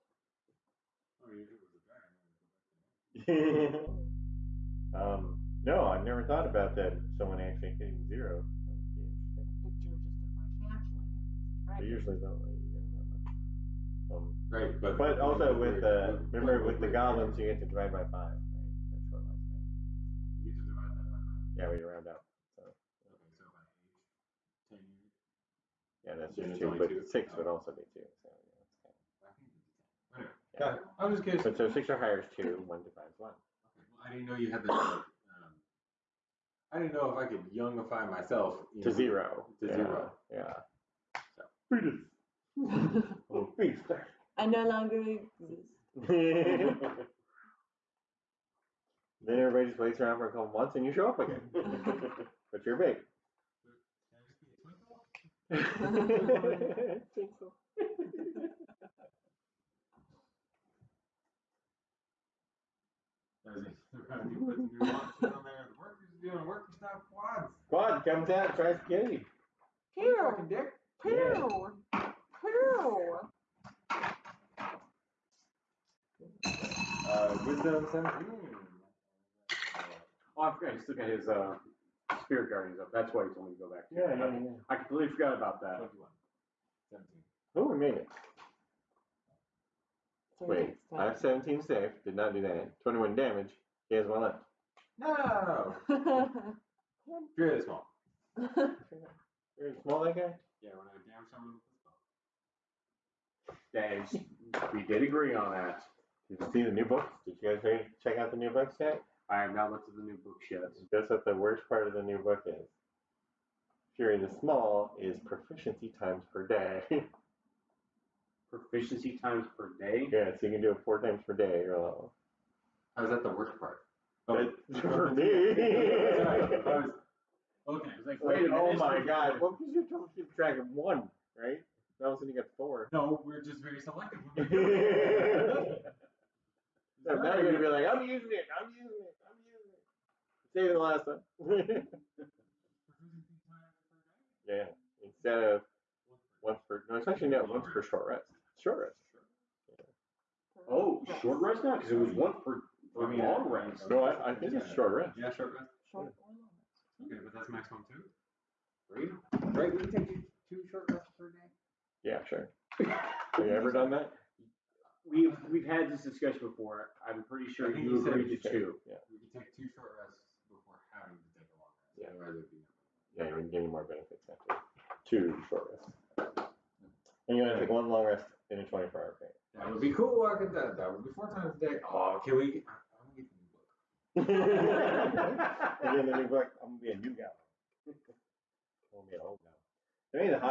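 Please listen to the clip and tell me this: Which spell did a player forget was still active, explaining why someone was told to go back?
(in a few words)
Spirit Guardians.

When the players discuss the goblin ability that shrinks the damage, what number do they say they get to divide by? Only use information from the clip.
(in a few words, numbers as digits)
5.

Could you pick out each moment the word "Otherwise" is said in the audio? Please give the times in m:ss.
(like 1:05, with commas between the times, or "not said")
2:52.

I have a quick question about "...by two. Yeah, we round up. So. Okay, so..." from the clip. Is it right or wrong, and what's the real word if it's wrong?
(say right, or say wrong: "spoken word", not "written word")
wrong: "five", not "two".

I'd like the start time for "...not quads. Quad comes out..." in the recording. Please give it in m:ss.
1:06.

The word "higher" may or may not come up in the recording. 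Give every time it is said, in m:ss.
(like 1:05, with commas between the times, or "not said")
0:31.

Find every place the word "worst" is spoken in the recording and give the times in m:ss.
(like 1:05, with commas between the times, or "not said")
1:51, 2:03.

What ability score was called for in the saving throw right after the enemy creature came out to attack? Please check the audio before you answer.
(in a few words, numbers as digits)
Wisdom.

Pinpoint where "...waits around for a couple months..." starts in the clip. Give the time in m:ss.
0:49.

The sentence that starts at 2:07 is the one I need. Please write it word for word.
Okay, like, wait oh my god.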